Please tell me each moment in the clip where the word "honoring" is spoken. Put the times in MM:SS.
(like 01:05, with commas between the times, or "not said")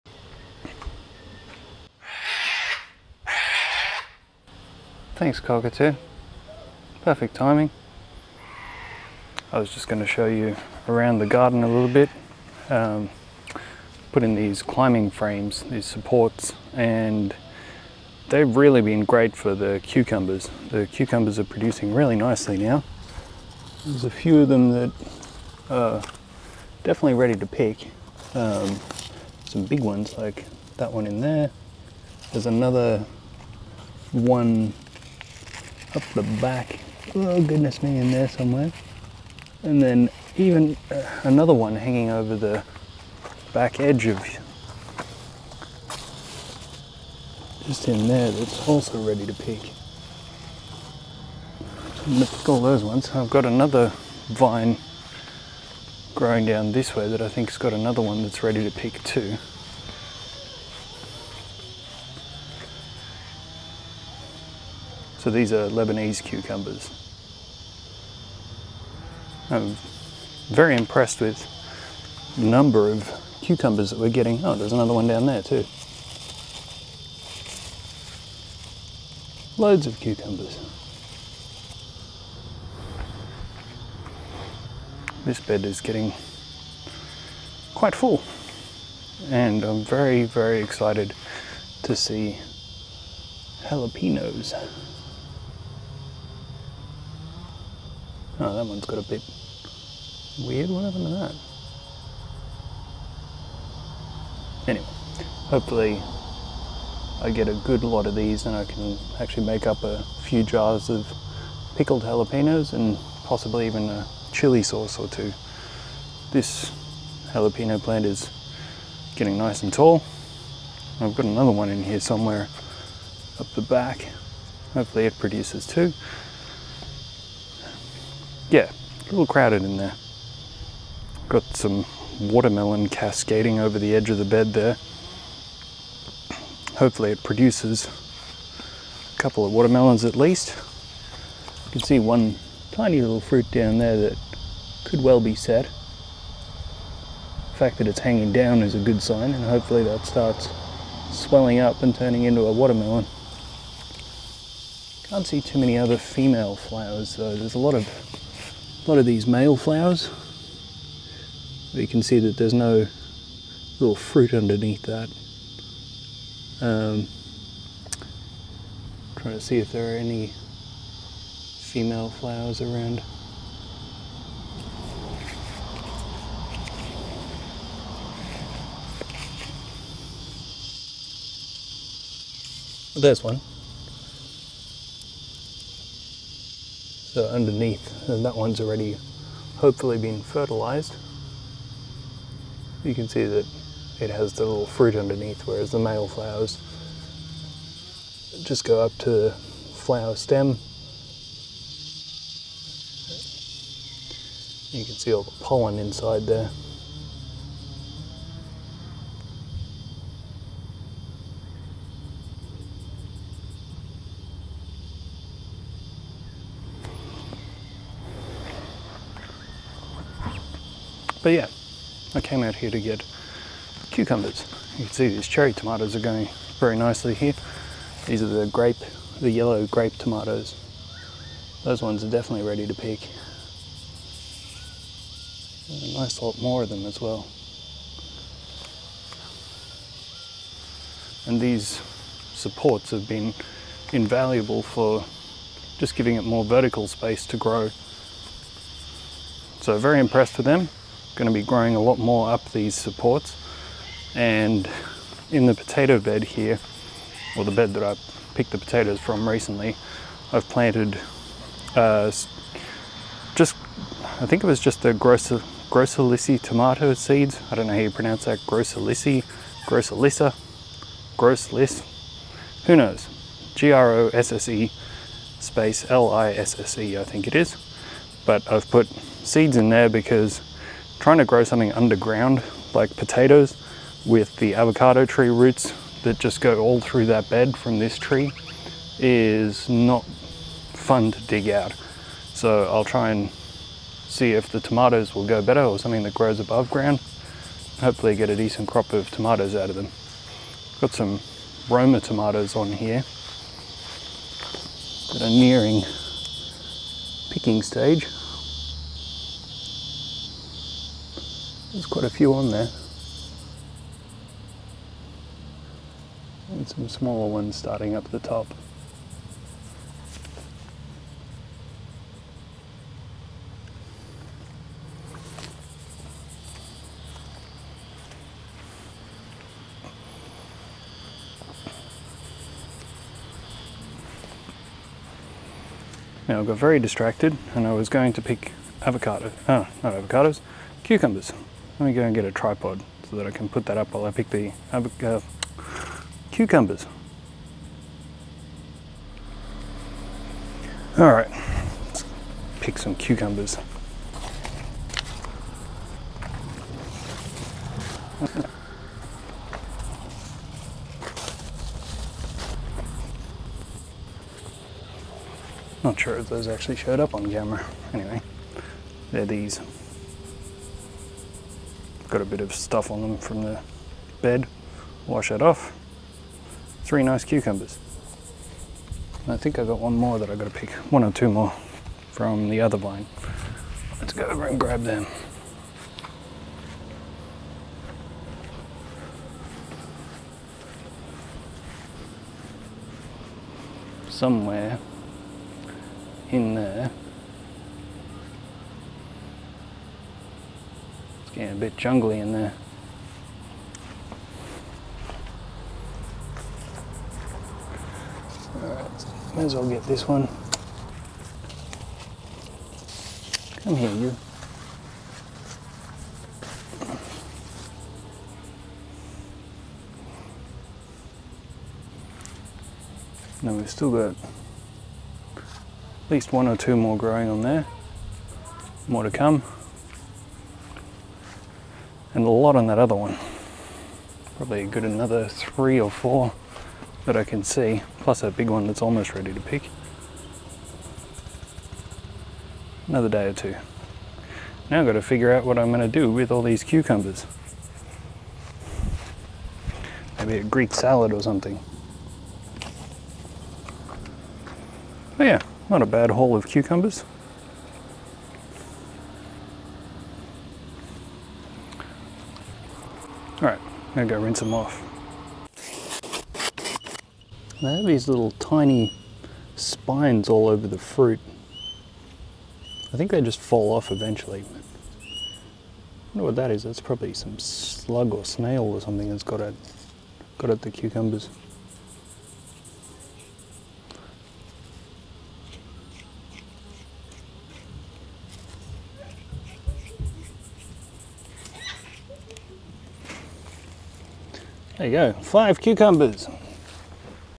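not said.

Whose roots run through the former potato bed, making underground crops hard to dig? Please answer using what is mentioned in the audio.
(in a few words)
avocado tree.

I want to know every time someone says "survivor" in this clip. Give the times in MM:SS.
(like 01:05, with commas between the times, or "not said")
not said.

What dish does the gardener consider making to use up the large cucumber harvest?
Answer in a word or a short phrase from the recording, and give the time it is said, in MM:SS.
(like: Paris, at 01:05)
Greek salad, at 07:30.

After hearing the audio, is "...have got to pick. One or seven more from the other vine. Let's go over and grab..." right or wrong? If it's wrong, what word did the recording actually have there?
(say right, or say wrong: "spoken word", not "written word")
wrong: "two", not "seven".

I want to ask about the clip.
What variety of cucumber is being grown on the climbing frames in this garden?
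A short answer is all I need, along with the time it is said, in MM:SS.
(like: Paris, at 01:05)
Lebanese, at 01:05.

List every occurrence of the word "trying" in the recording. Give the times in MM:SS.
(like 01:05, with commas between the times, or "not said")
02:49, 04:41.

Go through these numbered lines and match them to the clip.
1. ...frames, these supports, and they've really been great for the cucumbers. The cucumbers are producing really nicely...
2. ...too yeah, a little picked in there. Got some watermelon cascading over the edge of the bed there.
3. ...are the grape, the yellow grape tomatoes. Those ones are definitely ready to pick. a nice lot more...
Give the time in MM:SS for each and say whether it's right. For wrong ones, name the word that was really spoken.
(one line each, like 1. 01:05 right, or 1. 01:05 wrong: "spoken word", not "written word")
1. 00:15 right
2. 02:05 wrong: "crowded", not "picked"
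3. 03:48 right.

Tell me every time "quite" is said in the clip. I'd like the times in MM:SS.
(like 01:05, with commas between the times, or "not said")
01:27, 05:11.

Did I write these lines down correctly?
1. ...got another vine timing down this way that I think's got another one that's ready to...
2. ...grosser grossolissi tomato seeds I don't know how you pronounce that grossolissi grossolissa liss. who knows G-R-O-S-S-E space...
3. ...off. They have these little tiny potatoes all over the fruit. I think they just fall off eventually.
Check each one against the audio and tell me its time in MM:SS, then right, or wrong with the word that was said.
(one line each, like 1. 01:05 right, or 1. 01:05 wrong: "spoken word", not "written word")
1. 00:53 wrong: "growing", not "timing"
2. 04:24 right
3. 07:44 wrong: "spines", not "potatoes".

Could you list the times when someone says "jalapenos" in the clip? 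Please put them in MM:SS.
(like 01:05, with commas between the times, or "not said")
01:33, 01:52, 01:57.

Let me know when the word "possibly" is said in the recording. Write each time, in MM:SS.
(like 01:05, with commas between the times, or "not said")
01:53.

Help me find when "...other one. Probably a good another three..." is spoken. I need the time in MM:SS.
07:12.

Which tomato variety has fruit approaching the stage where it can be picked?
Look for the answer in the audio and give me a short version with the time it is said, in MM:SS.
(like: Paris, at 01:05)
Roma, at 05:01.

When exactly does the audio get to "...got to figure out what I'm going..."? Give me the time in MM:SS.
07:24.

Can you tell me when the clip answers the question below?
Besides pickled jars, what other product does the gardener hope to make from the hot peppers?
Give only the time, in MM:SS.
01:54.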